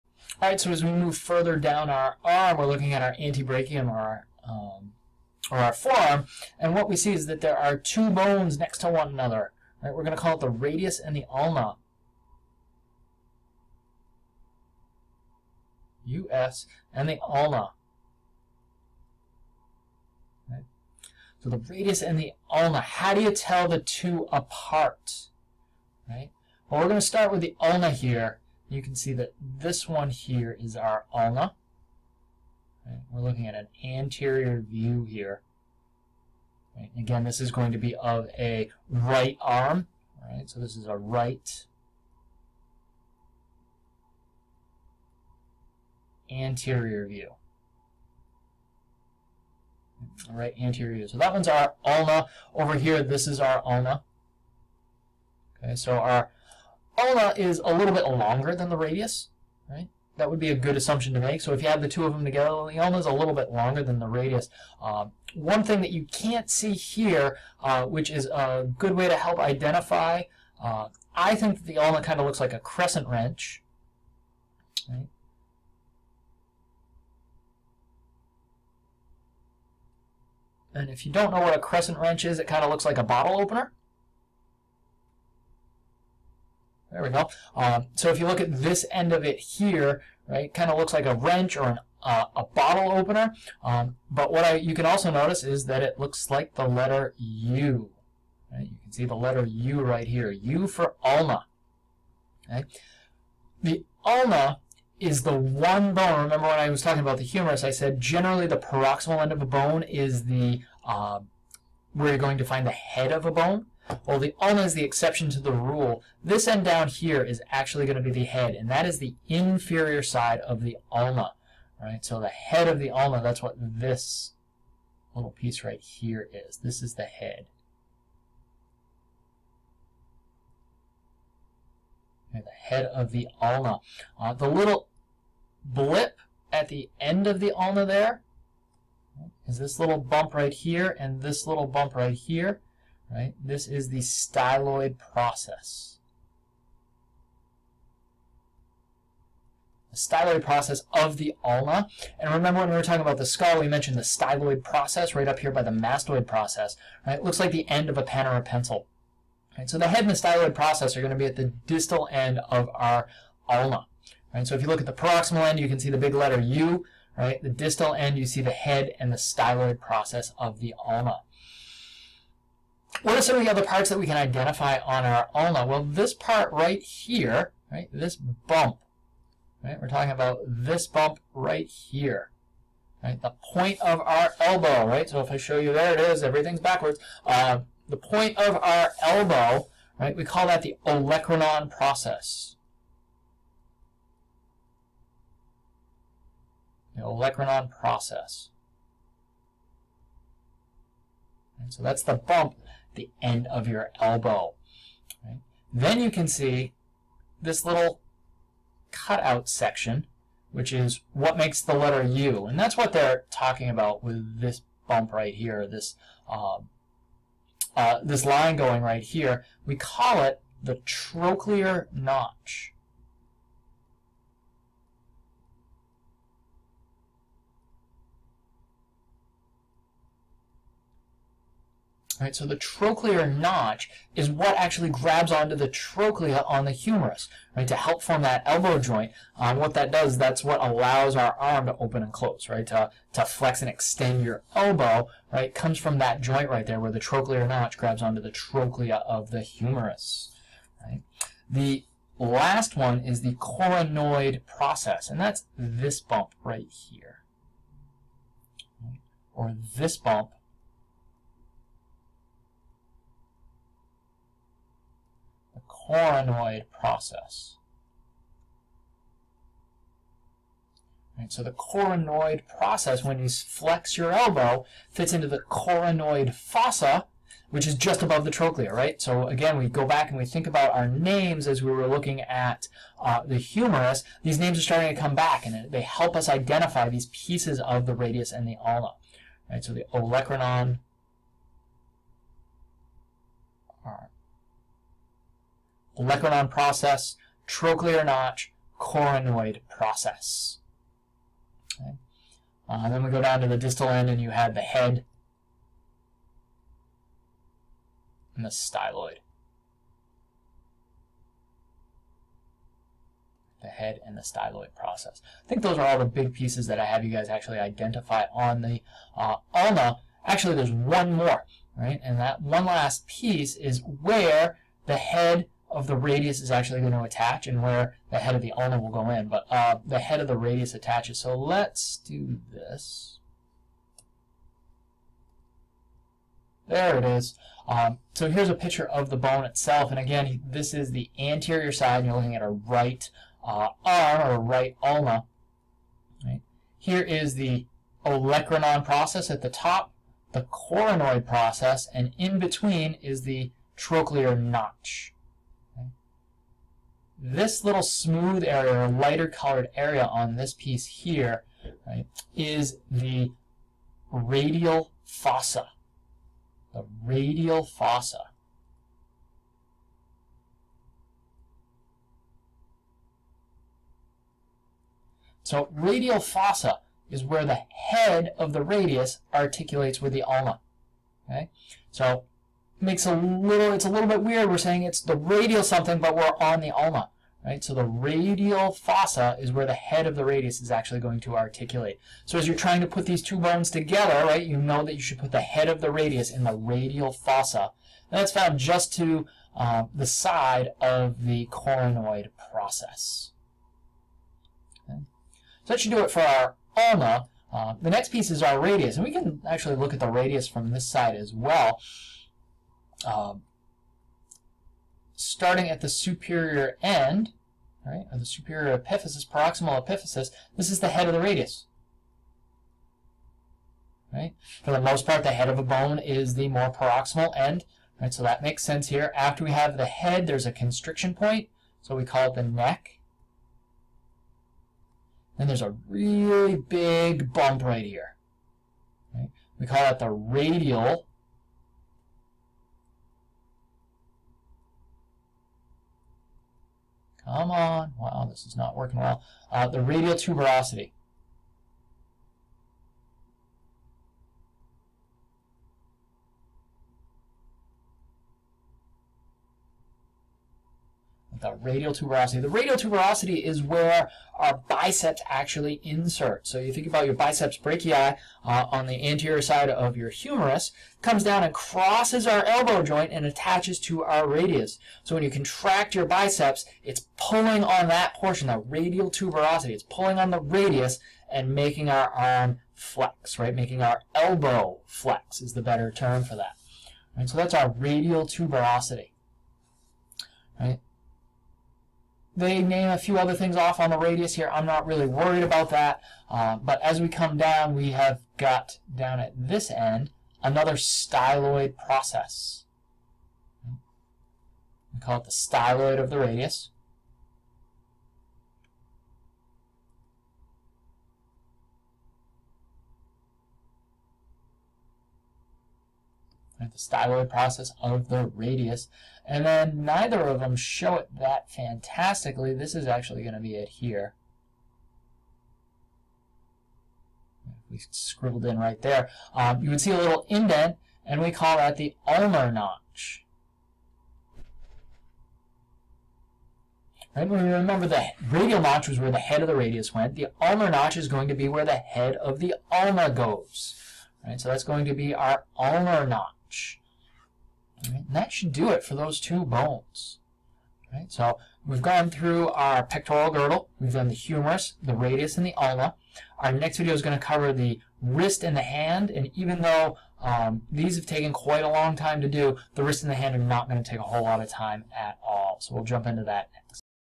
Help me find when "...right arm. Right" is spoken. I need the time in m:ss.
0:38.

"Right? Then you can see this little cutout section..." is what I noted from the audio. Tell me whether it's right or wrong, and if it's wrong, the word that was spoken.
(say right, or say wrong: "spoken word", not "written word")
right.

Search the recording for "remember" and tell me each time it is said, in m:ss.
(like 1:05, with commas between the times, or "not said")
1:46, 2:32, 8:57.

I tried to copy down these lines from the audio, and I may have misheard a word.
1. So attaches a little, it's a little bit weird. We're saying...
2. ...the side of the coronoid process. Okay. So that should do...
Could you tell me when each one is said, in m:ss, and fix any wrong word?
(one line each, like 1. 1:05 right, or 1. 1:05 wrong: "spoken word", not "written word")
1. 6:21 wrong: "makes", not "attaches"
2. 6:39 right.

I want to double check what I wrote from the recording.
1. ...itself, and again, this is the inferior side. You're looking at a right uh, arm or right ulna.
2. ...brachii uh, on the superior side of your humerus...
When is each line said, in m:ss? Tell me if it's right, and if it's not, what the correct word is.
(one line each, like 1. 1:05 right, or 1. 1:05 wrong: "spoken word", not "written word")
1. 5:39 wrong: "anterior", not "inferior"
2. 7:47 wrong: "anterior", not "superior".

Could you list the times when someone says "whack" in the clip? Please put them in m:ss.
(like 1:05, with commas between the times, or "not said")
not said.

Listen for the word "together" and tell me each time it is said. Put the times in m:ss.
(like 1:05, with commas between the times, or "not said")
1:02, 6:33.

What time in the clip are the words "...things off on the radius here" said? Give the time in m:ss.
8:13.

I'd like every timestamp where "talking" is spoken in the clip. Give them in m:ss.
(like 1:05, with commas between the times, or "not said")
1:46, 2:32, 2:59, 3:33.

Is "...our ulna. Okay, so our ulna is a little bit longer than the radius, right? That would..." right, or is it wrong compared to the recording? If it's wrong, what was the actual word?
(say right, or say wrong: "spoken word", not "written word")
right.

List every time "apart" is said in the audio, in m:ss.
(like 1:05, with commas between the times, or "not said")
0:24.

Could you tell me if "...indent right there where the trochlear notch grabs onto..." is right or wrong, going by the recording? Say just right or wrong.
wrong.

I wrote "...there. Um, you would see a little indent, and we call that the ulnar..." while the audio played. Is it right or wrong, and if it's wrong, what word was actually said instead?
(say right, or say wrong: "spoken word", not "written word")
right.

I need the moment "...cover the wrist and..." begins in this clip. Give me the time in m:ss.
9:17.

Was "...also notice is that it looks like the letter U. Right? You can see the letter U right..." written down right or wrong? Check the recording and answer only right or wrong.
right.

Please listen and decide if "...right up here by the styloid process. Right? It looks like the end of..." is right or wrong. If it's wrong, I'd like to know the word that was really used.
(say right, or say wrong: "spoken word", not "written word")
wrong: "mastoid", not "styloid".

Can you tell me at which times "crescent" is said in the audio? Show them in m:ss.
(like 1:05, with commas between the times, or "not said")
1:12, 1:21.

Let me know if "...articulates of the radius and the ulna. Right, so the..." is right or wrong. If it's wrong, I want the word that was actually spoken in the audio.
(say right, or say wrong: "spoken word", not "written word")
wrong: "pieces", not "articulates".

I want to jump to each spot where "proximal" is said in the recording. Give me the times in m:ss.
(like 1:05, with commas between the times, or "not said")
1:48, 2:44, 6:59, 7:06.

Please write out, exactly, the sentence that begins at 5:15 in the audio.
I think those are all the big pieces that I have you guys actually identify on the uh, ulna.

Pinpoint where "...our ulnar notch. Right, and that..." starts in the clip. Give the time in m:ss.
9:05.